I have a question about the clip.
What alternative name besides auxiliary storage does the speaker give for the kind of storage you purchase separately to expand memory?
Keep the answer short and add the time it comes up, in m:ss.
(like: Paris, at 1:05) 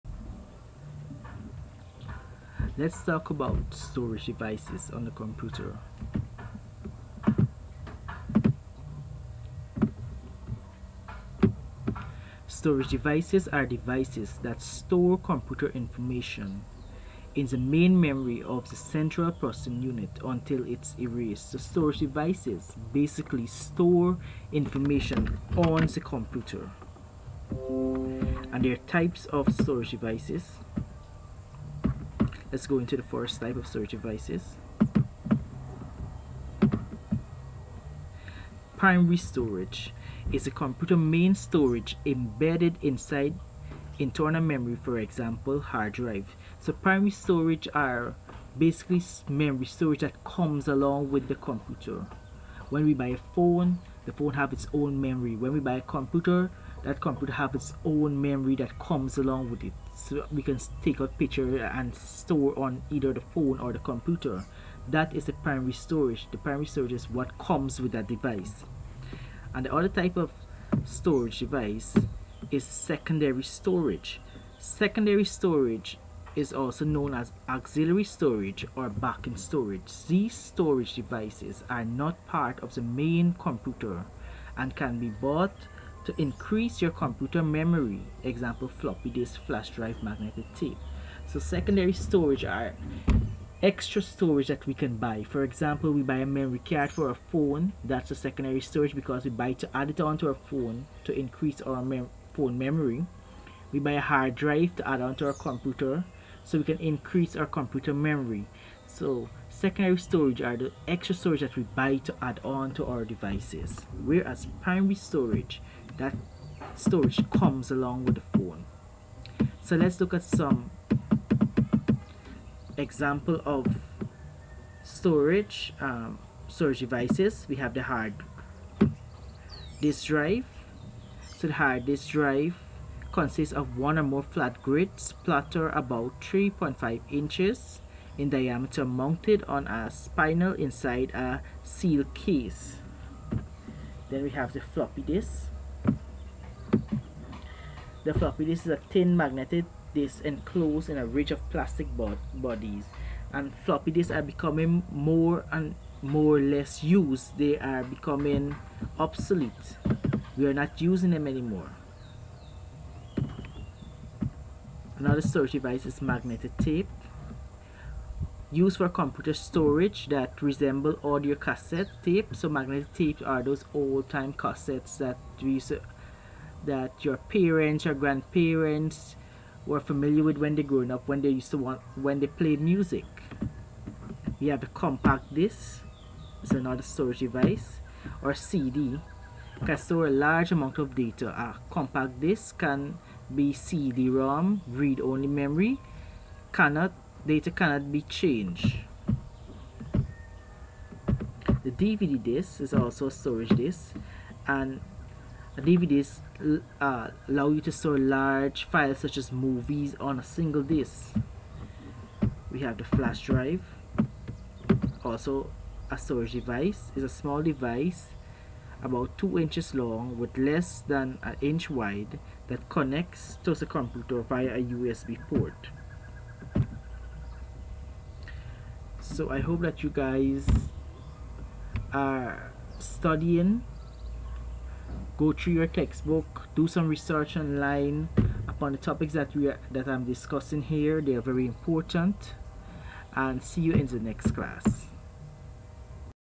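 Backing storage, at 1:18.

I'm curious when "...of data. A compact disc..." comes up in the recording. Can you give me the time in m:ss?
3:10.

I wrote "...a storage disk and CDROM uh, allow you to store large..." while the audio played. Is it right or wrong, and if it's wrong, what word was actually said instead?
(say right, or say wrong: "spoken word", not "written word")
wrong: "DVDs", not "CDROM".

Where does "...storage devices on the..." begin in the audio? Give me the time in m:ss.
0:03.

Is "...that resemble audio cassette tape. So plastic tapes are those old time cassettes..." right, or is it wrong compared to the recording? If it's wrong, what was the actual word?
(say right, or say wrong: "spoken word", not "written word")
wrong: "magnetic", not "plastic".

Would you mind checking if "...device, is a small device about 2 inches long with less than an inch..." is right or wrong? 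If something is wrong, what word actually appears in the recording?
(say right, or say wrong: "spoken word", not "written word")
right.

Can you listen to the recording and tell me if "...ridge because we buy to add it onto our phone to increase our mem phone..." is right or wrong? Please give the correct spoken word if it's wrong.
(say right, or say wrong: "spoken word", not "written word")
wrong: "storage", not "ridge".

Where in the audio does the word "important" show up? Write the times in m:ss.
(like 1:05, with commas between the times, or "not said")
4:01.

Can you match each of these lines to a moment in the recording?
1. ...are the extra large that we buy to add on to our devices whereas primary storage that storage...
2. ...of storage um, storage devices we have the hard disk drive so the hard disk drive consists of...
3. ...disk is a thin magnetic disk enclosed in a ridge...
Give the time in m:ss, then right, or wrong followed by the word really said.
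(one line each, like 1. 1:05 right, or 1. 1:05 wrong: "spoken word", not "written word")
1. 1:50 wrong: "storage", not "large"
2. 2:03 right
3. 2:28 right.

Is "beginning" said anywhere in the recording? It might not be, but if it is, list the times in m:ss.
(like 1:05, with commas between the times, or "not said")
not said.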